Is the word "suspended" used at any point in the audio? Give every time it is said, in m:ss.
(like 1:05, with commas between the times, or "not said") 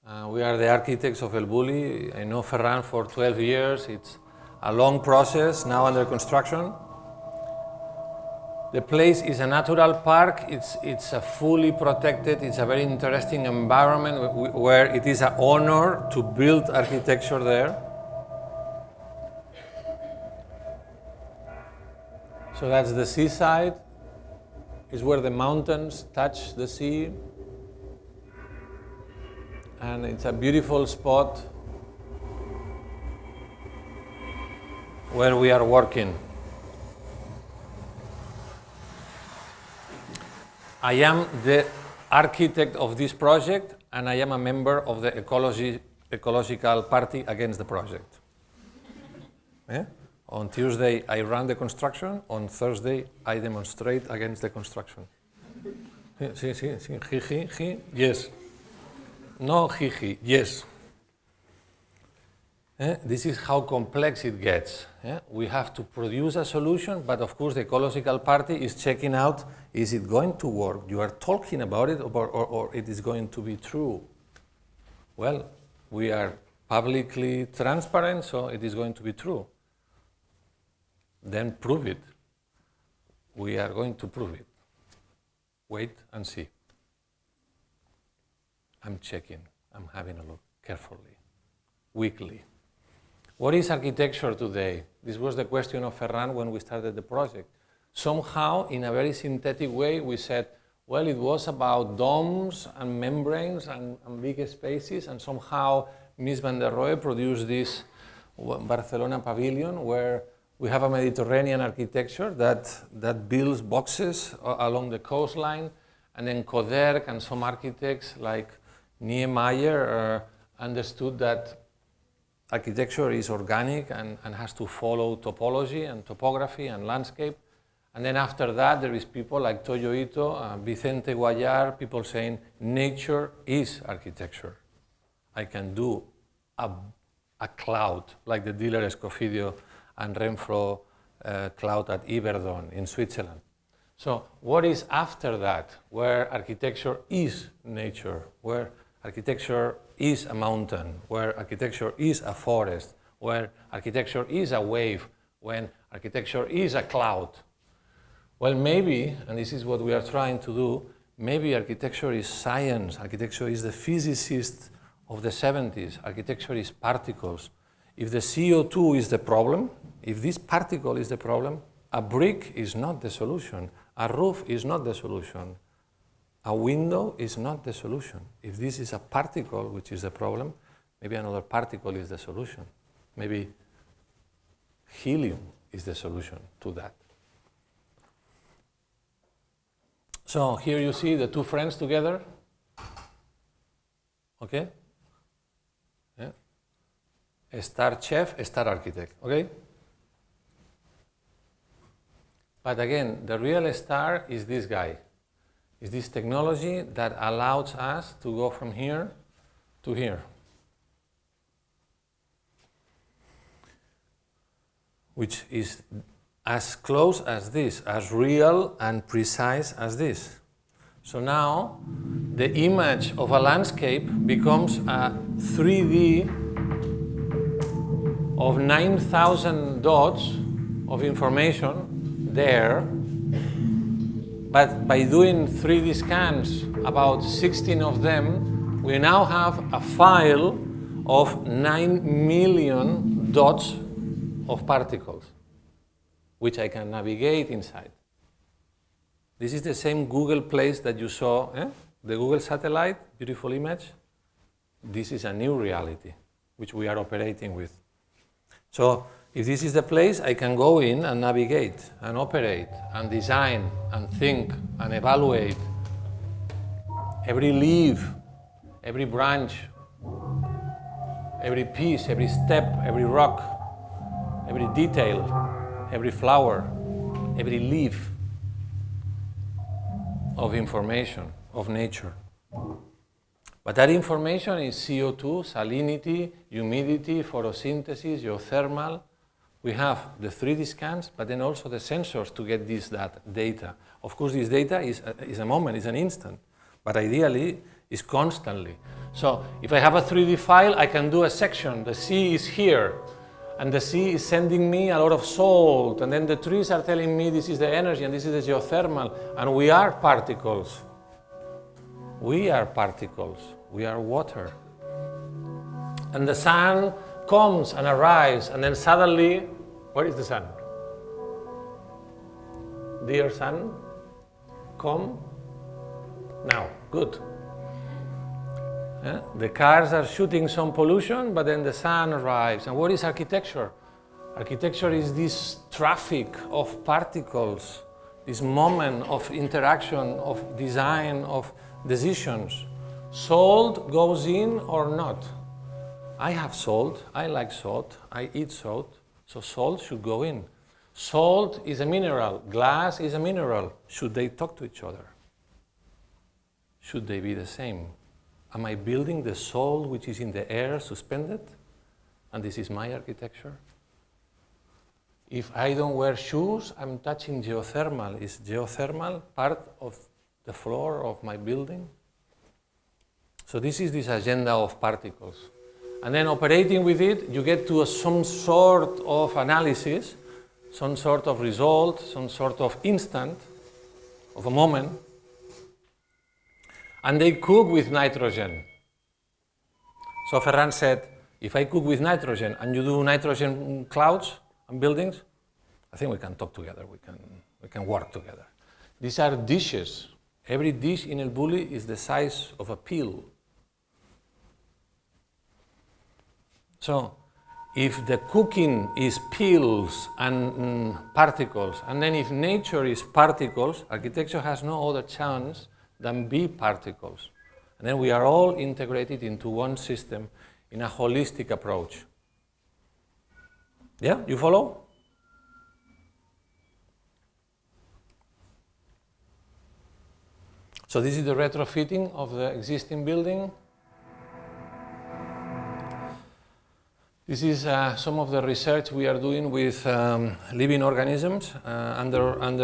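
6:00.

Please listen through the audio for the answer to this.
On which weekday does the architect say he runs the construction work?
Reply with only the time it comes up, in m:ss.
0:50.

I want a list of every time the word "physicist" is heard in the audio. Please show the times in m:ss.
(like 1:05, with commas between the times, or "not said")
2:43.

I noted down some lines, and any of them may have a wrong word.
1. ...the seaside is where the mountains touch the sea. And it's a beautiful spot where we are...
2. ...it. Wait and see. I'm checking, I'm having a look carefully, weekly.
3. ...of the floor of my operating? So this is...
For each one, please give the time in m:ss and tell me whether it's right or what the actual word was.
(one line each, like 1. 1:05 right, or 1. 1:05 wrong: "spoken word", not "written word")
1. 0:22 right
2. 1:24 right
3. 6:09 wrong: "building", not "operating".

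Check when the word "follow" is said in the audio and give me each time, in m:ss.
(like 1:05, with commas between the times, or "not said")
2:04, 7:04.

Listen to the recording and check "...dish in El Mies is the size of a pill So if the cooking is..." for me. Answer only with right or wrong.
wrong.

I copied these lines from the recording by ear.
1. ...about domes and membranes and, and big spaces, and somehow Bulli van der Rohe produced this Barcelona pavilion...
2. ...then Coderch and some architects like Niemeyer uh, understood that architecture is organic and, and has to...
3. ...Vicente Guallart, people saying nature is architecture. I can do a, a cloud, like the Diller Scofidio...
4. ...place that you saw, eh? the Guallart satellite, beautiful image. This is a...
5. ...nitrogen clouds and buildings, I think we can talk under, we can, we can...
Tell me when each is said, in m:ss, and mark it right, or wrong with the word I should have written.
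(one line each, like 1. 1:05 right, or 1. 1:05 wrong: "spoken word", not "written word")
1. 1:41 wrong: "Mies", not "Bulli"
2. 1:56 right
3. 2:10 right
4. 4:10 wrong: "Google", not "Guallart"
5. 6:33 wrong: "together", not "under".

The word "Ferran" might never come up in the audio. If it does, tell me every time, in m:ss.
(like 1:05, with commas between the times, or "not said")
0:02, 1:35, 6:30.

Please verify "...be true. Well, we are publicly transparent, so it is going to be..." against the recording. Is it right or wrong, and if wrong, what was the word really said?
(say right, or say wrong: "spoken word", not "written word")
right.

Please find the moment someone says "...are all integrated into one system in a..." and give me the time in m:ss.
6:58.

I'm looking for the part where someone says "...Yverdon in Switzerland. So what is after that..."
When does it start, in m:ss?
2:22.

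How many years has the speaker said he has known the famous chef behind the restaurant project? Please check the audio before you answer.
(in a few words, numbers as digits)
12 years.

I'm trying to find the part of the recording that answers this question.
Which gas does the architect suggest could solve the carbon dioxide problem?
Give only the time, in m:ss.
3:04.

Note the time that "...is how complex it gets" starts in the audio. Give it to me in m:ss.
1:03.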